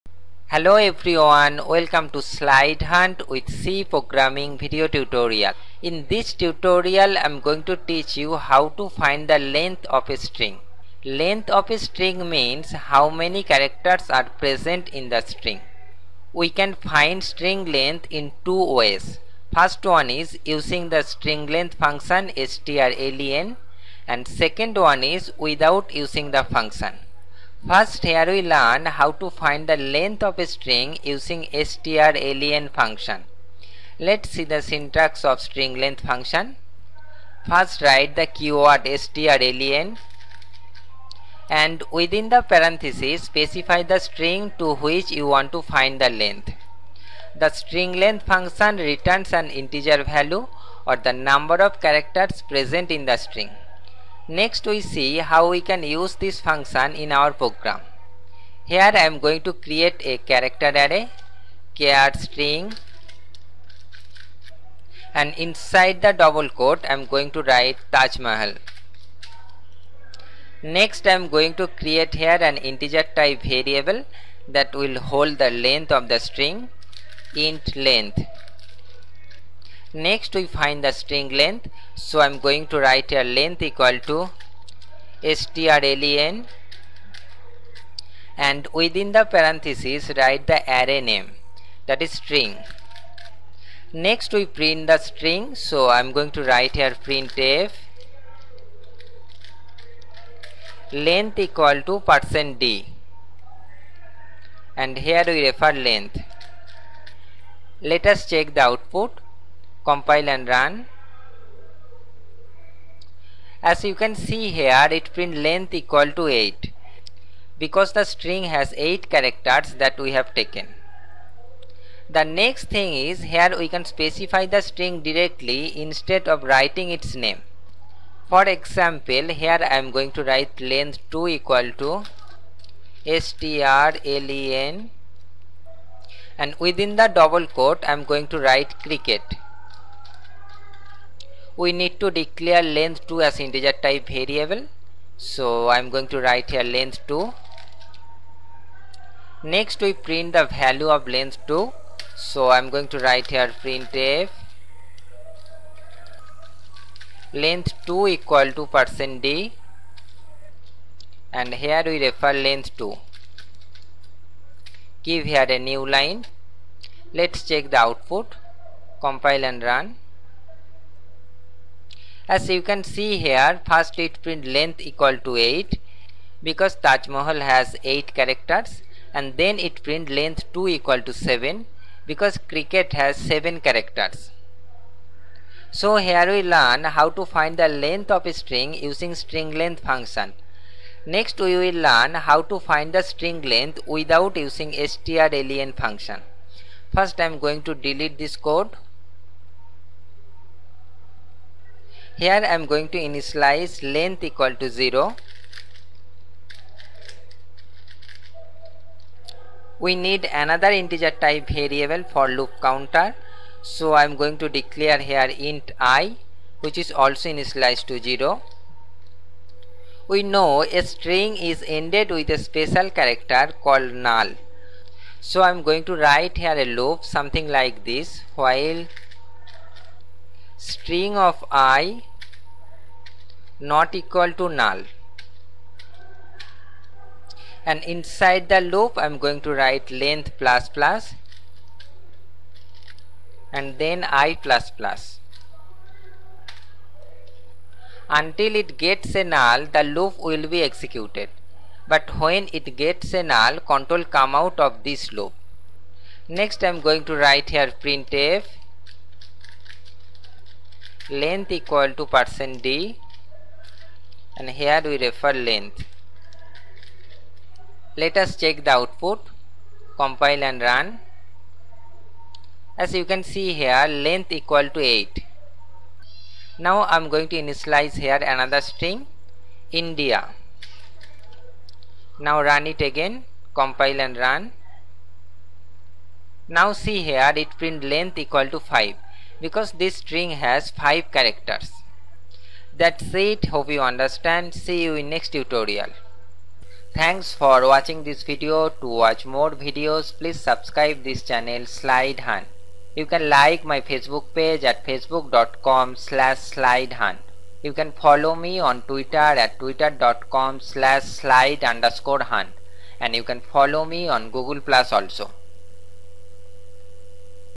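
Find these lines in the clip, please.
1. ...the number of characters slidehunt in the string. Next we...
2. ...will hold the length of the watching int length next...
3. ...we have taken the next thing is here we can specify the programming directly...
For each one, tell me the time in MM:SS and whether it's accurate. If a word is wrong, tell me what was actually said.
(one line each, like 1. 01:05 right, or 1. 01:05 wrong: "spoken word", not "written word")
1. 00:50 wrong: "present", not "slidehunt"
2. 01:14 wrong: "string", not "watching"
3. 02:00 wrong: "string", not "programming".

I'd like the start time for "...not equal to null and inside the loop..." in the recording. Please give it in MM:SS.
03:53.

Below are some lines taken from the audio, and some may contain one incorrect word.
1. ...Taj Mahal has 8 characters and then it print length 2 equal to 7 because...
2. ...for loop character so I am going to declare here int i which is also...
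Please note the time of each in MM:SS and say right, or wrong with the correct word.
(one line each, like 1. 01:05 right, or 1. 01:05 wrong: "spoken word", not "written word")
1. 02:56 right
2. 03:32 wrong: "counter", not "character".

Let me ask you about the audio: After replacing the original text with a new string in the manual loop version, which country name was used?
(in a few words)
India.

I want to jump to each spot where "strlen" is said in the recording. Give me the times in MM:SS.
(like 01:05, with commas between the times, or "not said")
00:22, 00:31, 00:39, 01:25, 02:13, 03:14.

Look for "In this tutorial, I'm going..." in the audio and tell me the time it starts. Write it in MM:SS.
00:05.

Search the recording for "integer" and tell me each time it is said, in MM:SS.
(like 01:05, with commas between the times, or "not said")
00:49, 01:12, 02:23, 03:30.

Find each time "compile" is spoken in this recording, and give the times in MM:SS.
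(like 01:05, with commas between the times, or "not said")
01:49, 02:49, 04:29, 04:43.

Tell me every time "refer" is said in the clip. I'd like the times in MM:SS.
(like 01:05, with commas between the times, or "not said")
01:45, 02:42, 04:24.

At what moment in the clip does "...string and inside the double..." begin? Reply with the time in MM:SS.
01:02.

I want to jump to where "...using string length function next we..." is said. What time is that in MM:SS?
03:08.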